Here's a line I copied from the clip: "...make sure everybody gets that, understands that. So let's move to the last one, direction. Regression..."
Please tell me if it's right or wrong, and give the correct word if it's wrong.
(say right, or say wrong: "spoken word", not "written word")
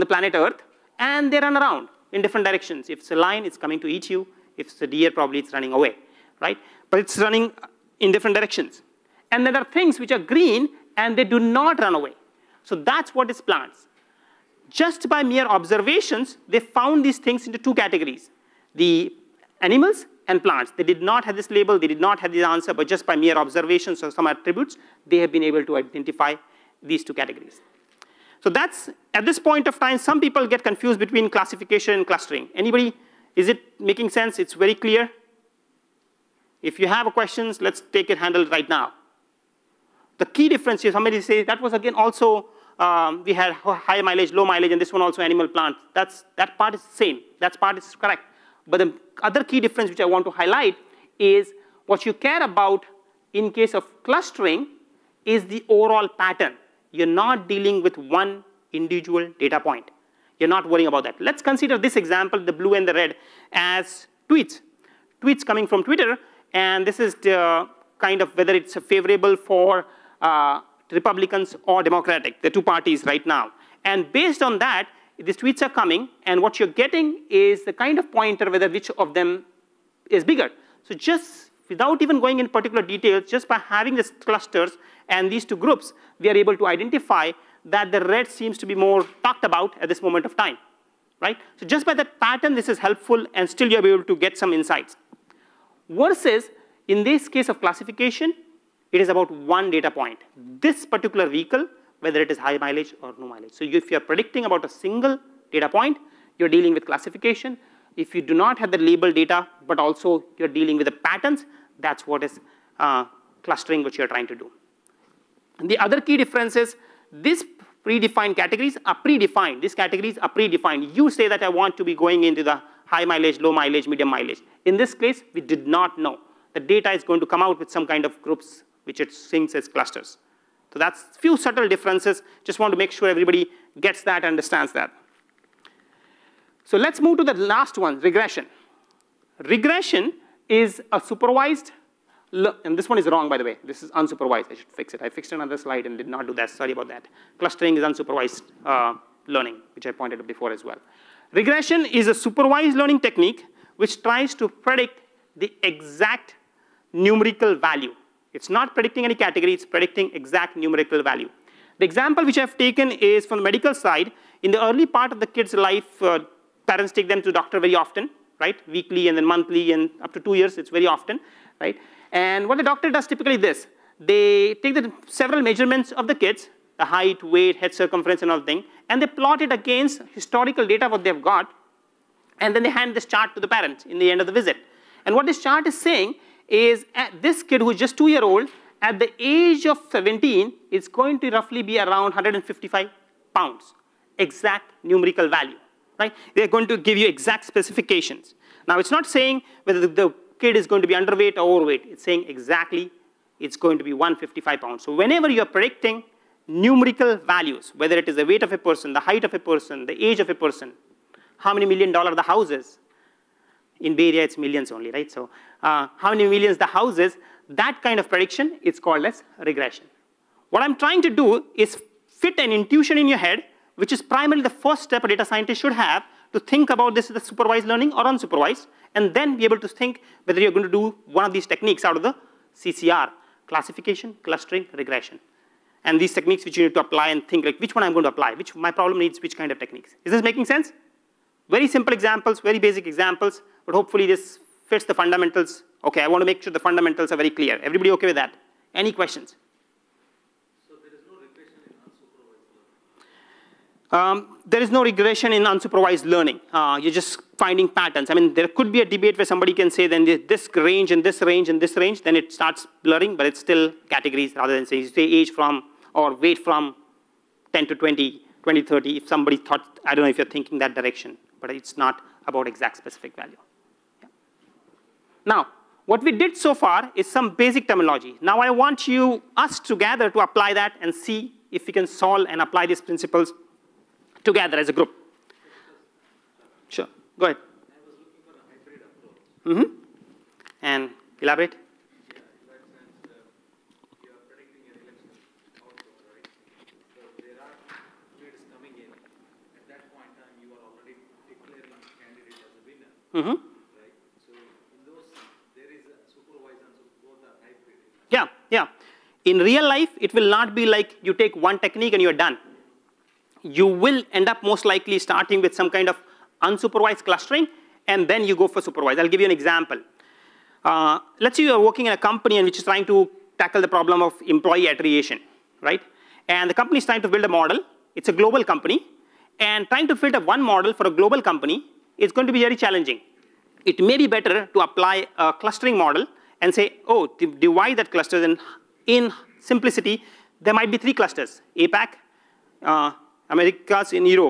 wrong: "regression", not "direction".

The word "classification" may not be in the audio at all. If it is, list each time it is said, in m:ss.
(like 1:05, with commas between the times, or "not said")
0:31, 1:37, 1:46, 3:53.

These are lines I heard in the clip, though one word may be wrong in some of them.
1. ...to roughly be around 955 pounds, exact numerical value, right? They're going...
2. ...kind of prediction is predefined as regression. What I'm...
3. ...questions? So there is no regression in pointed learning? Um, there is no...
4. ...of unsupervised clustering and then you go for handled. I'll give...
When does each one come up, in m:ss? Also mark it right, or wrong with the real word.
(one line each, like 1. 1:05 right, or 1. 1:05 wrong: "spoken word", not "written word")
1. 3:11 wrong: "155", not "955"
2. 3:37 wrong: "called", not "predefined"
3. 4:08 wrong: "unsupervised", not "pointed"
4. 5:15 wrong: "supervised", not "handled".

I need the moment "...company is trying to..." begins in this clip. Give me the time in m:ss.
5:26.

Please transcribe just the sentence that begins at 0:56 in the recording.
You're not dealing with one individual data point.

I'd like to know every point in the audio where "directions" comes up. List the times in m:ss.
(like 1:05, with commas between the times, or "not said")
0:02, 0:08, 4:30.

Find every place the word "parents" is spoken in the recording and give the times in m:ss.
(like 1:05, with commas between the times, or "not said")
2:46, 3:03.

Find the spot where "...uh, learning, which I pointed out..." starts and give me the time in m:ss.
2:28.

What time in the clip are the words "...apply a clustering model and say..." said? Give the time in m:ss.
5:34.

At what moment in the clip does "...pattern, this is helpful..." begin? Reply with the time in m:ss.
1:32.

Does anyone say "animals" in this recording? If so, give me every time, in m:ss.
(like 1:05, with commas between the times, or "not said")
0:19, 0:45.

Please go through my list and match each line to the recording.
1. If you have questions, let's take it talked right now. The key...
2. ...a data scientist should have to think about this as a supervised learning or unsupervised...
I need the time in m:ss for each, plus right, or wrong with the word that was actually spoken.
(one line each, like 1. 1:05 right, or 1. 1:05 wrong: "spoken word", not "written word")
1. 0:36 wrong: "handled", not "talked"
2. 3:45 right.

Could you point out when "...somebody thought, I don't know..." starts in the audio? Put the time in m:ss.
4:29.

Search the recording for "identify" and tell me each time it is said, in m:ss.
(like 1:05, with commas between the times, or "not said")
0:25, 1:26.